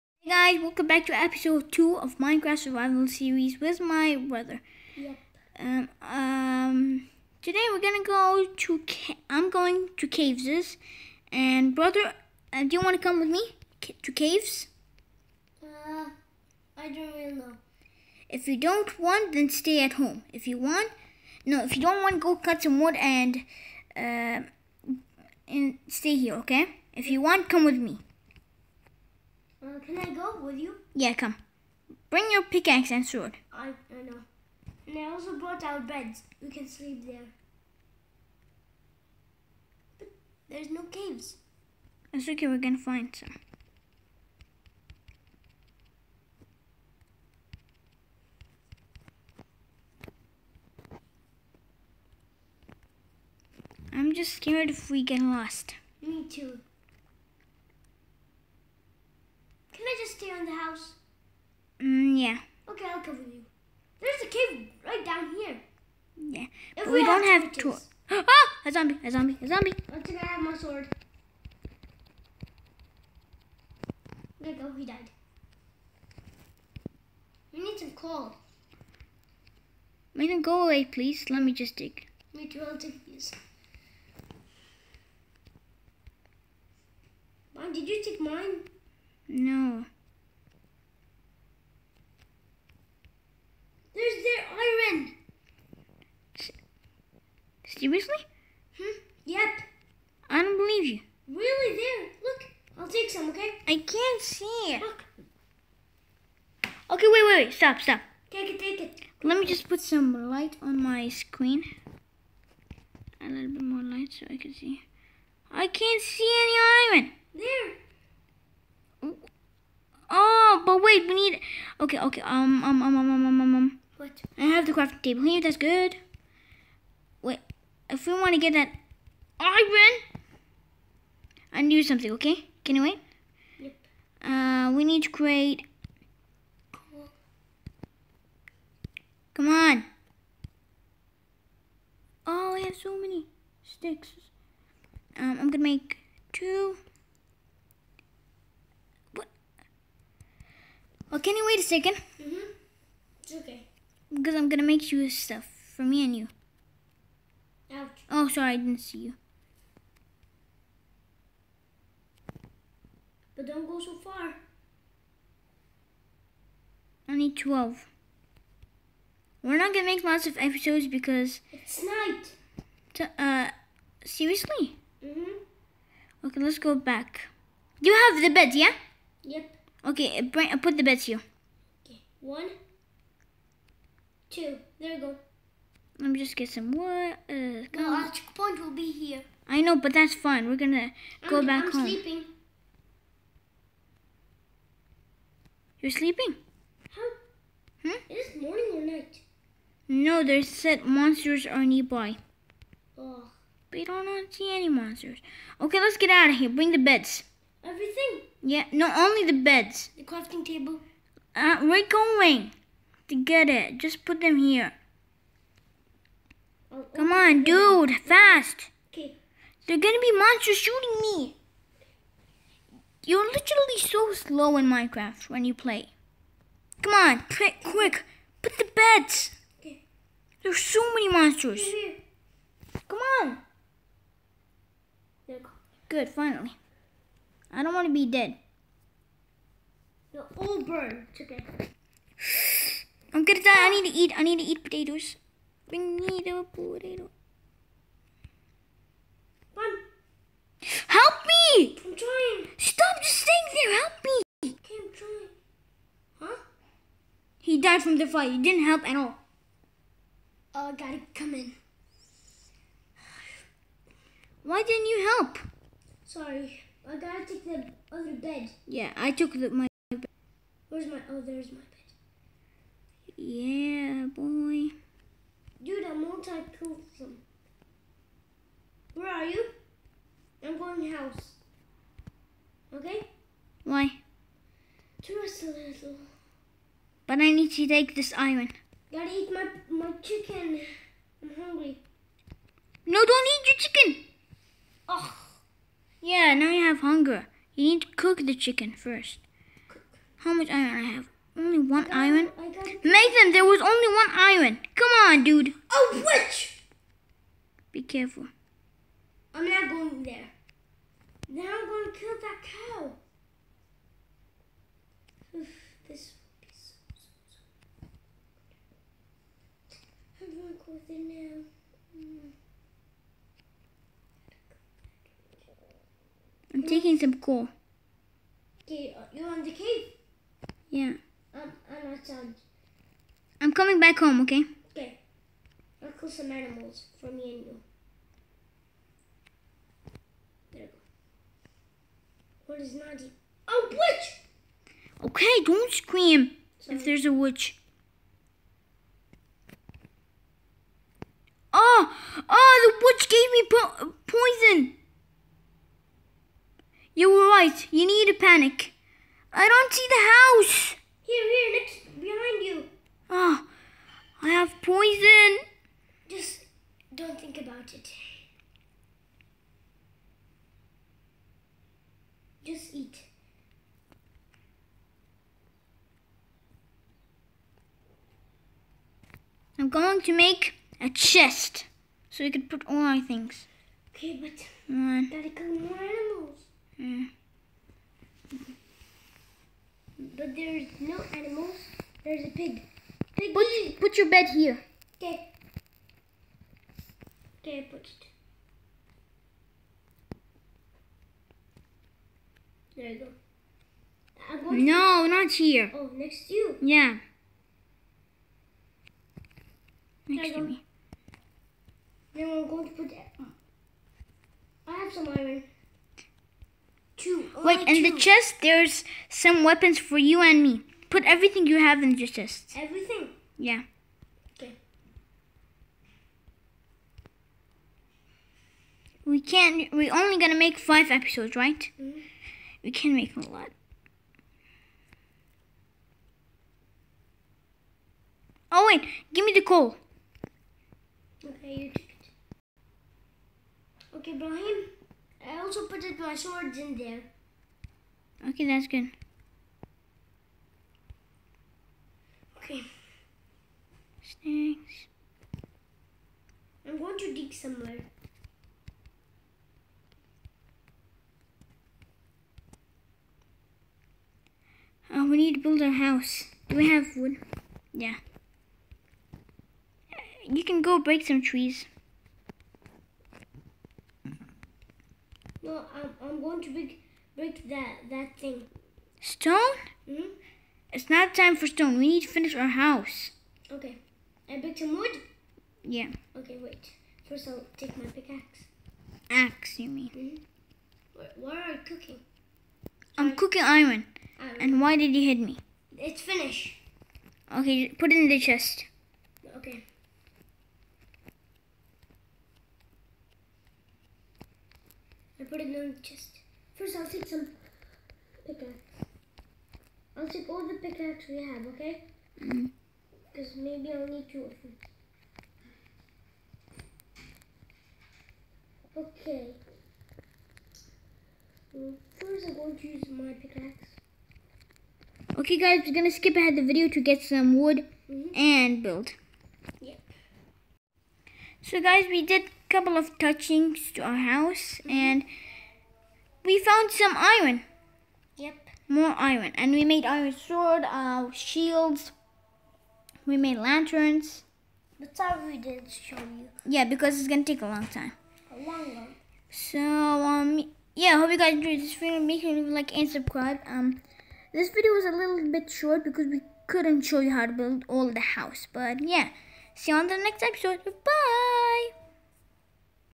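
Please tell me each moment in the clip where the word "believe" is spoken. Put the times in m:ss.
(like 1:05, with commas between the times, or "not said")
1:40.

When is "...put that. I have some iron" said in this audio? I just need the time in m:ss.
6:52.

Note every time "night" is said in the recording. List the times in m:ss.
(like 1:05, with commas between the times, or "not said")
2:51, 3:18.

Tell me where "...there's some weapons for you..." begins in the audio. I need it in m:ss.
6:58.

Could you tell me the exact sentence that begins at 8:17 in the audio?
Okay, put it in the chest.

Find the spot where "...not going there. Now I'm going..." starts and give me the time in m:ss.
5:09.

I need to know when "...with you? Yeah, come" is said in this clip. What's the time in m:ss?
0:30.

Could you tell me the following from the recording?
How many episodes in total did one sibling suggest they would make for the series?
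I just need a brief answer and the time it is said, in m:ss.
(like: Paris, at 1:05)
5, at 7:10.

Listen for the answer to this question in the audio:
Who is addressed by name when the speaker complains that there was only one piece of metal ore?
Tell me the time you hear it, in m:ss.
5:02.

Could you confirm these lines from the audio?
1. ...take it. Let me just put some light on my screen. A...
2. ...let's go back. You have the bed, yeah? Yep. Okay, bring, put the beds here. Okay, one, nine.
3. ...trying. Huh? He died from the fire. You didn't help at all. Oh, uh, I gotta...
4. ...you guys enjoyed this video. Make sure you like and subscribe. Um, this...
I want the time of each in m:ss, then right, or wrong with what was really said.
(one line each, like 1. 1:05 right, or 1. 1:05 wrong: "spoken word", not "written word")
1. 1:48 right
2. 2:56 wrong: "two", not "nine"
3. 4:14 right
4. 9:11 right.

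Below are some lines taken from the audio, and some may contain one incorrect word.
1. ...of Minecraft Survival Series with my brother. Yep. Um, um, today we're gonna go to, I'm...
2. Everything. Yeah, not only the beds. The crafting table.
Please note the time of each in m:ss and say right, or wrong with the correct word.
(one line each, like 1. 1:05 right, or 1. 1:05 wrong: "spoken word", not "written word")
1. 0:01 right
2. 3:27 right.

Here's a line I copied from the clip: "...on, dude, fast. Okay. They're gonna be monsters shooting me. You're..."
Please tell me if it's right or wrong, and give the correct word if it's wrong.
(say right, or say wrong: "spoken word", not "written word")
right.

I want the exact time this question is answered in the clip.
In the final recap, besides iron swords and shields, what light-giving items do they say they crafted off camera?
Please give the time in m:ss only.
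9:03.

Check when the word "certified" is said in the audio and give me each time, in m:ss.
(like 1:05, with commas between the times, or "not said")
not said.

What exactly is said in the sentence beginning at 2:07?
Wait, if we want to get that iron, I need something.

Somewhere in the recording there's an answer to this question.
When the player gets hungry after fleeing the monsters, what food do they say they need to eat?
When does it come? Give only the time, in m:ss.
4:04.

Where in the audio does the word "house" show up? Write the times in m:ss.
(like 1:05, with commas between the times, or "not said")
1:00, 4:40, 6:00, 7:45, 8:02, 8:54, 9:17.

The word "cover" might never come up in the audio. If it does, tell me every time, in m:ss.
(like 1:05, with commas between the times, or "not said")
1:03.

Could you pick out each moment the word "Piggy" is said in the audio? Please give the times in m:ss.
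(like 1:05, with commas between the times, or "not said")
6:33.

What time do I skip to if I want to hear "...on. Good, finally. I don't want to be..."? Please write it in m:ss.
3:53.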